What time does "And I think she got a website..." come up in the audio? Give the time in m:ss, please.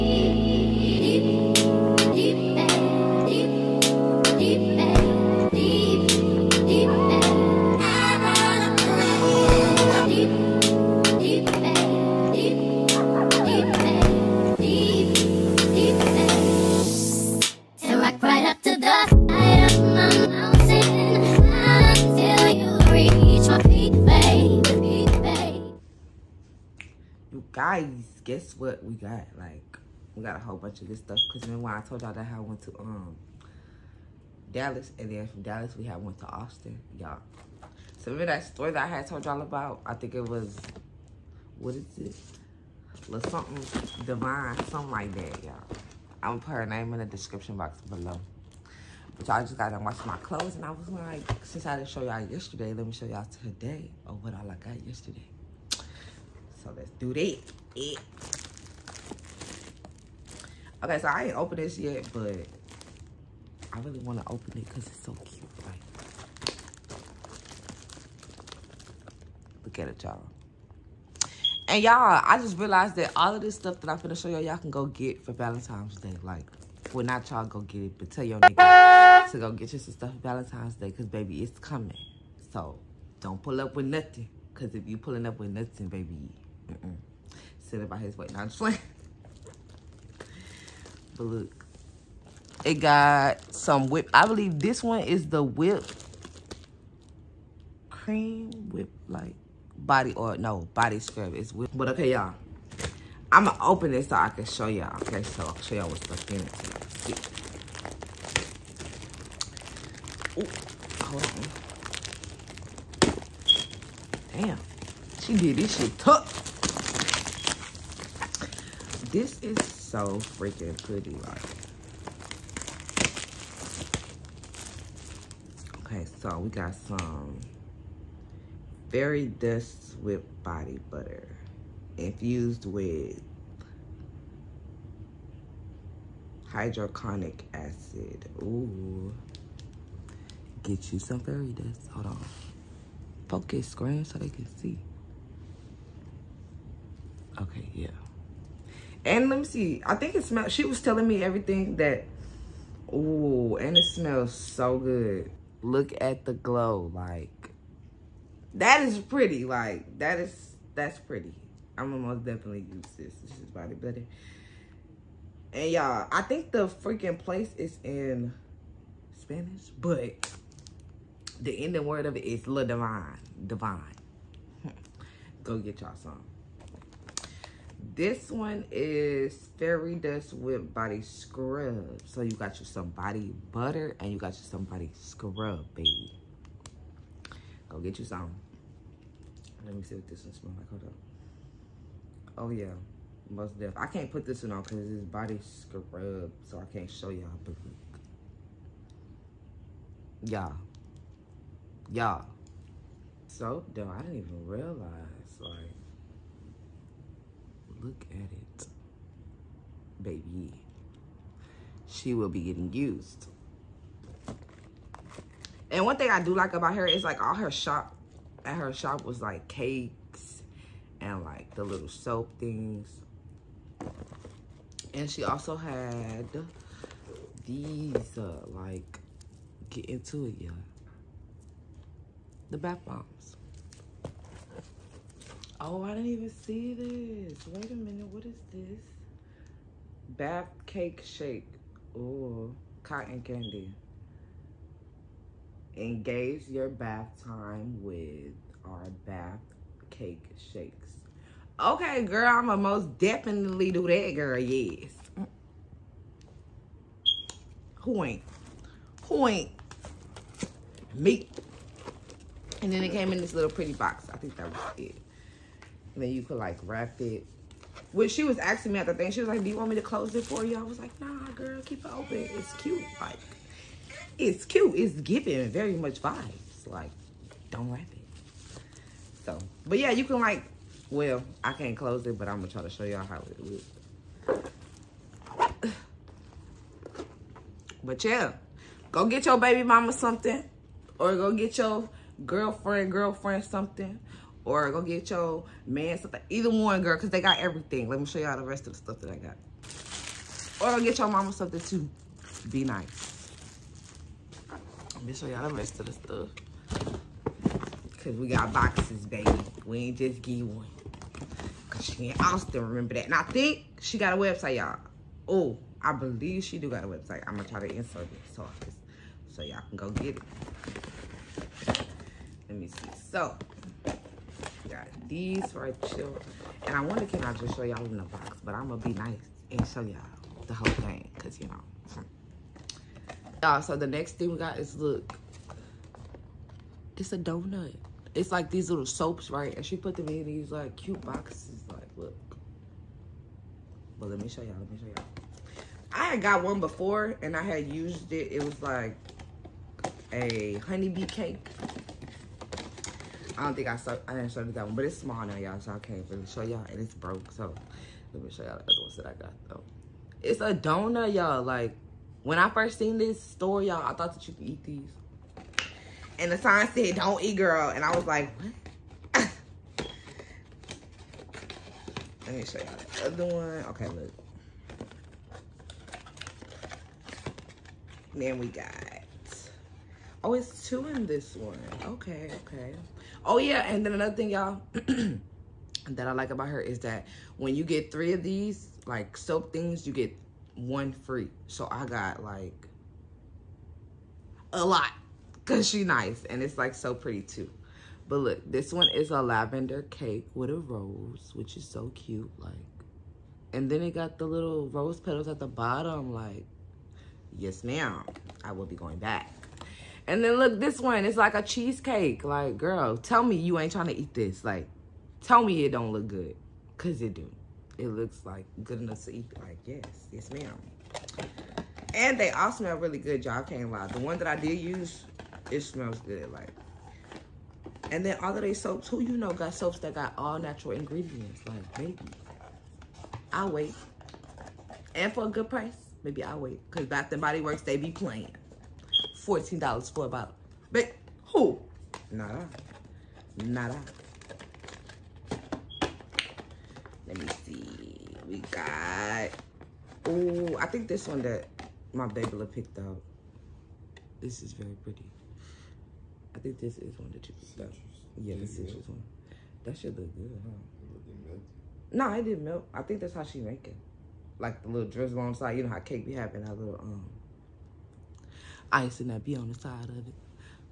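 5:13.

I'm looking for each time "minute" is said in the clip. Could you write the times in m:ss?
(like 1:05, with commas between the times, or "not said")
3:57.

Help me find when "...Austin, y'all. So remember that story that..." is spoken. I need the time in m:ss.
0:36.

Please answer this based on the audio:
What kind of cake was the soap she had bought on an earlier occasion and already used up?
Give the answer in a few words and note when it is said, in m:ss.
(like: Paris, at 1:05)
Honeybee cake, at 5:50.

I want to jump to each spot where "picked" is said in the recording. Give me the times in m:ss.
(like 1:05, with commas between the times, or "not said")
7:32, 7:37.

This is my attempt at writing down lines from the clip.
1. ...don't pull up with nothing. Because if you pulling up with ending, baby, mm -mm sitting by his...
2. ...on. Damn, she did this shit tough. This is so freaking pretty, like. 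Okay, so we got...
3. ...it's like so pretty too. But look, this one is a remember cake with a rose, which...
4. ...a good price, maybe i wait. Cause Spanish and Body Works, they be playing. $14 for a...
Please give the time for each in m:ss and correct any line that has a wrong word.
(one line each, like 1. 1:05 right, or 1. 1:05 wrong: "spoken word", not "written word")
1. 1:23 wrong: "nothing", not "ending"
2. 1:54 right
3. 6:36 wrong: "lavender", not "remember"
4. 7:15 wrong: "Bath", not "Spanish".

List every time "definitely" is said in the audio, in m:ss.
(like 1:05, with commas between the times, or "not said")
2:42, 3:13, 4:12.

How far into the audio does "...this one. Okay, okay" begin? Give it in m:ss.
6:21.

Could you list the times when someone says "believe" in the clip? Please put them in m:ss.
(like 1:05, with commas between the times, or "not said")
1:34, 5:15.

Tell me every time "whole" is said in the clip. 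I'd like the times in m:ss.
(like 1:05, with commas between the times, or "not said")
0:30, 5:30.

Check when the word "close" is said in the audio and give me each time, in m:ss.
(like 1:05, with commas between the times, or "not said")
4:29, 4:41.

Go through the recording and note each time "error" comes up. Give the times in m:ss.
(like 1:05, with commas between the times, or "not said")
not said.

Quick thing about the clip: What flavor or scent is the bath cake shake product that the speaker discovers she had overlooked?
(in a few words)
Cotton candy.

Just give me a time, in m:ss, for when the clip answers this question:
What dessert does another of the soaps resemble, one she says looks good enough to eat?
6:51.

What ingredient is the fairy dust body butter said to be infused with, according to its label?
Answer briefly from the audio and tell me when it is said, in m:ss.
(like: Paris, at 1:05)
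hydroconic acid, at 2:16.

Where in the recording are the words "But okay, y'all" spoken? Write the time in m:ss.
1:41.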